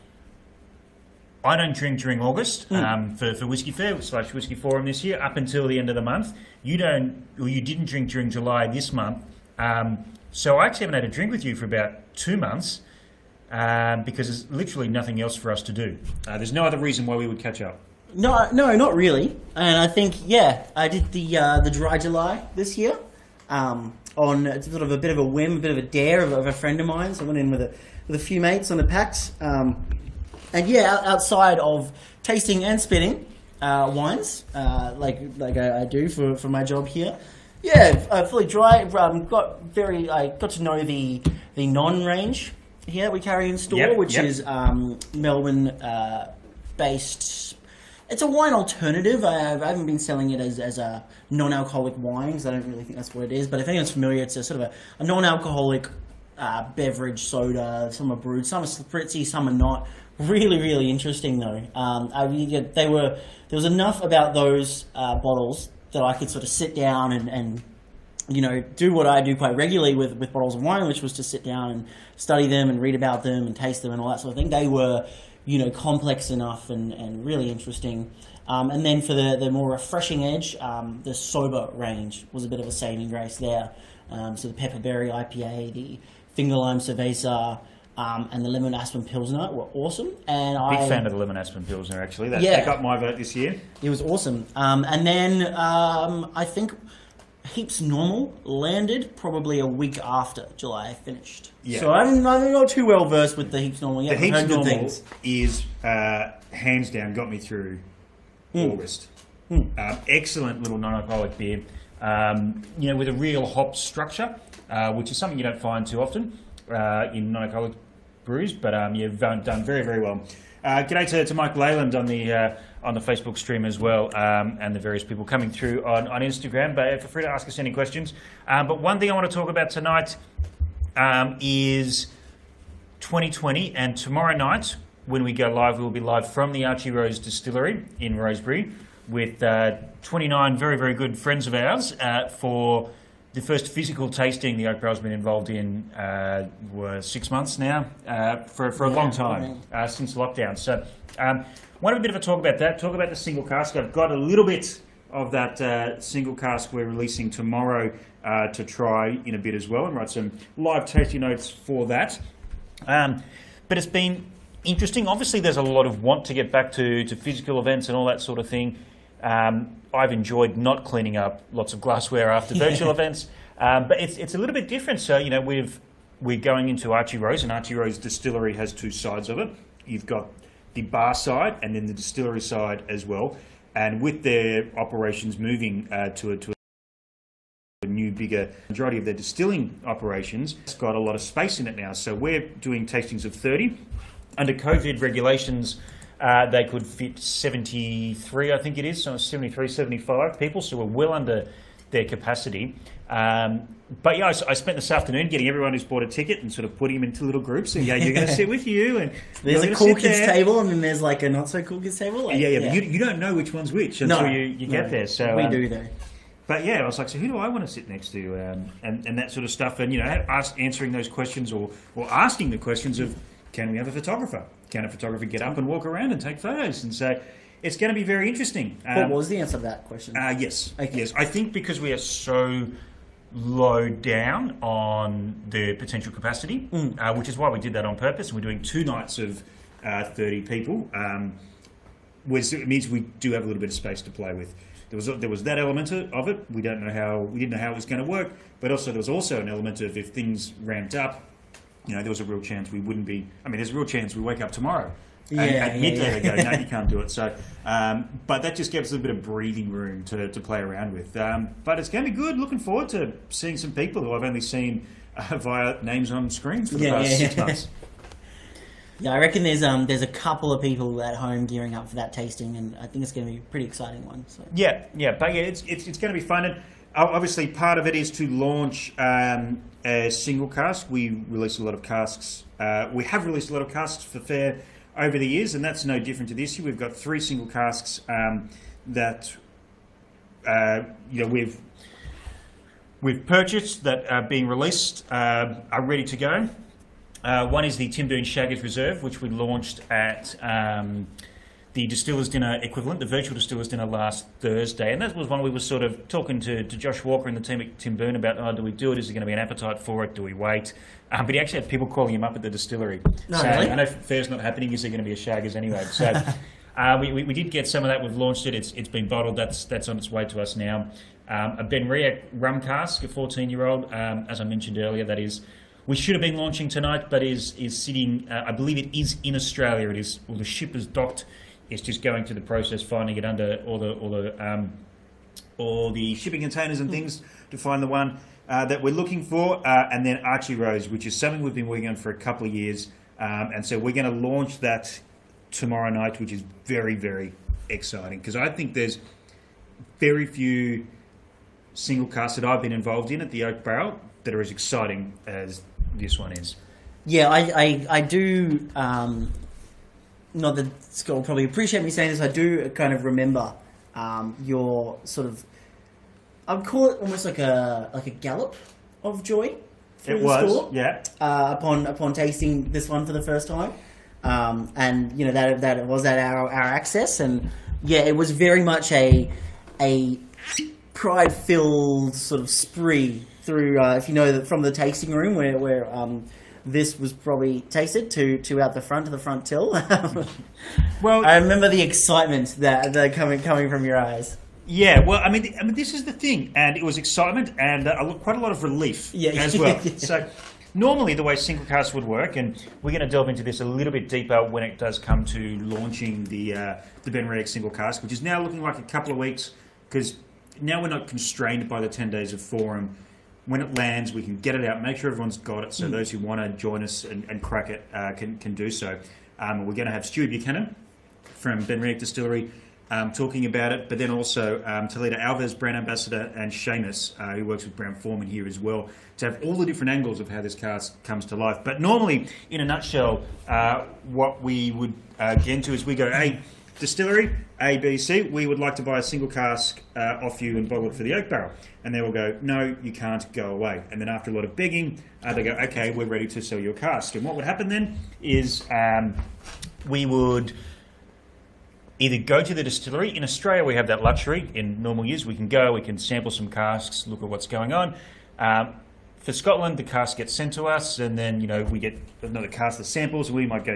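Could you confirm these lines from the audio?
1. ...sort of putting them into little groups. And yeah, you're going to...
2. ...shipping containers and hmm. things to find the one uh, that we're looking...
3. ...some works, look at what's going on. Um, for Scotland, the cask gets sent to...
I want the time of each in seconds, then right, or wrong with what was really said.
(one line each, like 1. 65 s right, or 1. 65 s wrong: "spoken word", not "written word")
1. 206 s right
2. 336 s right
3. 456 s wrong: "casks", not "works".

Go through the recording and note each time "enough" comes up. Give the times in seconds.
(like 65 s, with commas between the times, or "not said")
63 s, 76 s.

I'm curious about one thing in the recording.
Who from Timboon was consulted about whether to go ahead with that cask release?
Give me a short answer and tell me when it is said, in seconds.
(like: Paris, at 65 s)
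Josh Walker, at 306 s.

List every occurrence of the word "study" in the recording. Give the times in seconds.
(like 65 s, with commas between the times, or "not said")
72 s.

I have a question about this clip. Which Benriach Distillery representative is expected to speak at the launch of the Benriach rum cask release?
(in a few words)
Stuart Buchanan.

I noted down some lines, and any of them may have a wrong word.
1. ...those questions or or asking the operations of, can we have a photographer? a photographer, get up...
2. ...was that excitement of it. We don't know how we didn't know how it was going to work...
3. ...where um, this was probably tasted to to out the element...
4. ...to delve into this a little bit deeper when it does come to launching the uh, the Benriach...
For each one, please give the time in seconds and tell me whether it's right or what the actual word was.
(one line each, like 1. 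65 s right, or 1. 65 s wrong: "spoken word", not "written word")
1. 220 s wrong: "questions", not "operations"
2. 245 s wrong: "element", not "excitement"
3. 385 s wrong: "front", not "element"
4. 403 s right.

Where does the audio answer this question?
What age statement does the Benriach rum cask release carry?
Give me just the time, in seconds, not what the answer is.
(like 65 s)
323 s.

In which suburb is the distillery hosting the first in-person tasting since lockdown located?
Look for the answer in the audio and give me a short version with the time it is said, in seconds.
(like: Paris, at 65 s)
Rosebery, at 138 s.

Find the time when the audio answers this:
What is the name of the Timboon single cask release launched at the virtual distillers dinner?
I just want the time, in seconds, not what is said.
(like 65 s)
298 s.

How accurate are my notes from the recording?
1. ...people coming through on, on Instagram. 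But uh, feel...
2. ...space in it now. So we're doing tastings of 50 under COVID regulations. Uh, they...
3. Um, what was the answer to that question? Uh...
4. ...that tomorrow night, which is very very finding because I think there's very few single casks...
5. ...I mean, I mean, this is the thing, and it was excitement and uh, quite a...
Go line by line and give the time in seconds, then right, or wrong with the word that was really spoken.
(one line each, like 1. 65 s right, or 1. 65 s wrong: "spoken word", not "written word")
1. 125 s right
2. 191 s wrong: "30", not "50"
3. 228 s right
4. 344 s wrong: "exciting", not "finding"
5. 395 s right.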